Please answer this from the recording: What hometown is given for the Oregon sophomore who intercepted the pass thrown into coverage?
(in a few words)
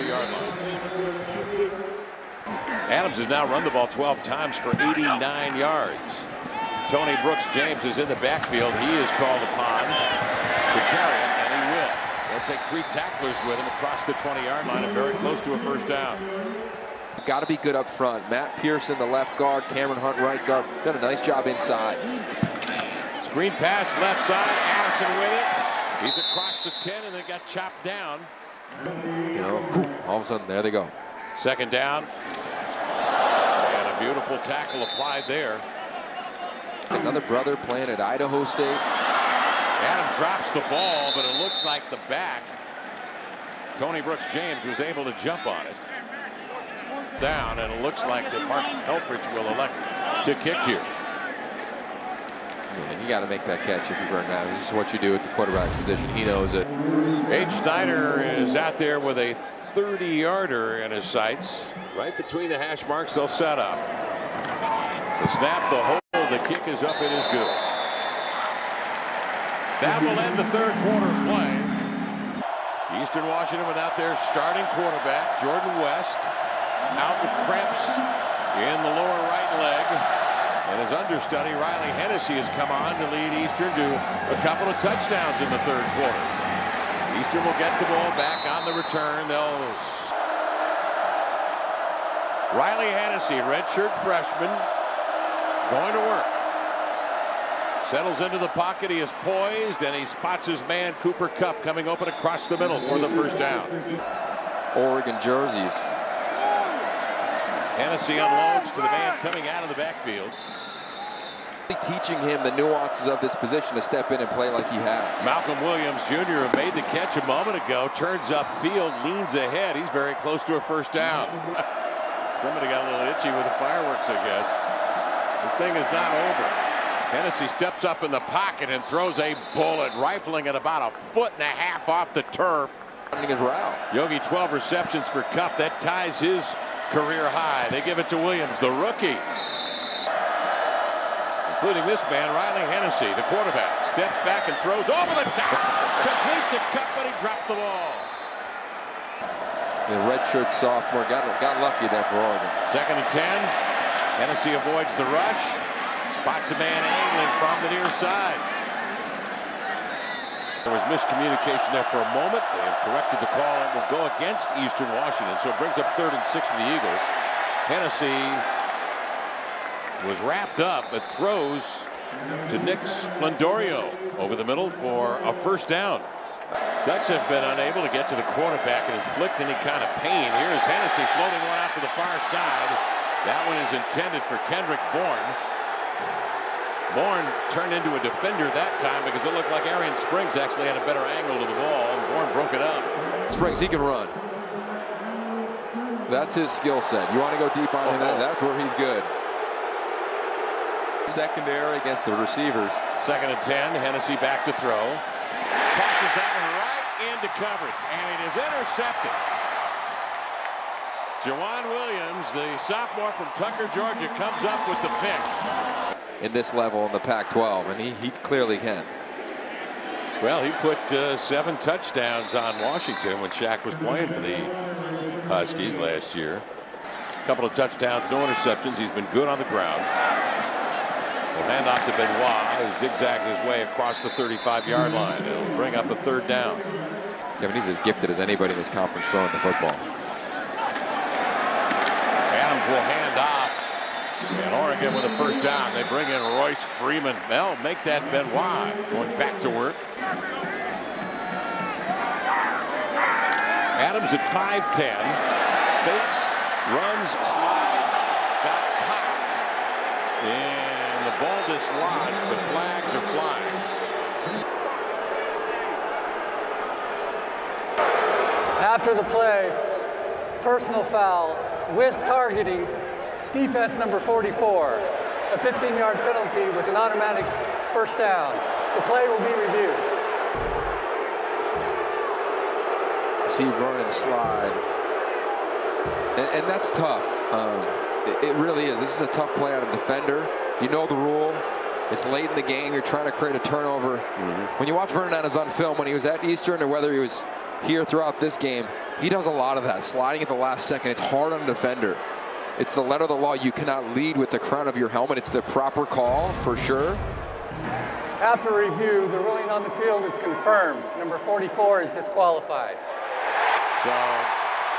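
Tucker, Georgia.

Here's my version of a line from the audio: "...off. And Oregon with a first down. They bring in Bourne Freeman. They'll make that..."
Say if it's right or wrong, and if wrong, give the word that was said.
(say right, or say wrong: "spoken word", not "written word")
wrong: "Royce", not "Bourne".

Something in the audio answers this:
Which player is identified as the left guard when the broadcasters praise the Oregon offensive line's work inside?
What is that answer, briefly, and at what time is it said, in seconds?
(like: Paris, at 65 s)
Matt Pearson, at 18 s.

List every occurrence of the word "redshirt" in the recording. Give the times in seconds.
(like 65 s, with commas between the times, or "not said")
93 s, 150 s.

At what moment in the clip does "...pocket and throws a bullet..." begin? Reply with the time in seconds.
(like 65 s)
128 s.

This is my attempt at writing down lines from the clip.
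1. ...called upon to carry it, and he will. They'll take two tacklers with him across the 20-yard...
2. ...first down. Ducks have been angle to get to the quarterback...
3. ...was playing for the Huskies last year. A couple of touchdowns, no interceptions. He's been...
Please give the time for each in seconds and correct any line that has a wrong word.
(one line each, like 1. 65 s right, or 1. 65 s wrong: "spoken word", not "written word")
1. 9 s wrong: "three", not "two"
2. 175 s wrong: "unable", not "angle"
3. 223 s right.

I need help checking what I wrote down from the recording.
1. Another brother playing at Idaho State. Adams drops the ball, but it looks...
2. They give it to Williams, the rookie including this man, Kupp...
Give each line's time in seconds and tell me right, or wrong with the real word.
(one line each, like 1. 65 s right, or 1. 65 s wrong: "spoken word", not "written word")
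1. 36 s right
2. 137 s wrong: "Riley", not "Kupp".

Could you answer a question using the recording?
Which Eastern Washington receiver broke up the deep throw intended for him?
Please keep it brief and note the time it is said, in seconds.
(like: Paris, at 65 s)
Kendrick Bourne, at 184 s.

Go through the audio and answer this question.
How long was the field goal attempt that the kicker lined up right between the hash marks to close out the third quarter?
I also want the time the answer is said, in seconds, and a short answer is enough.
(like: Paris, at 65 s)
30 yards, at 59 s.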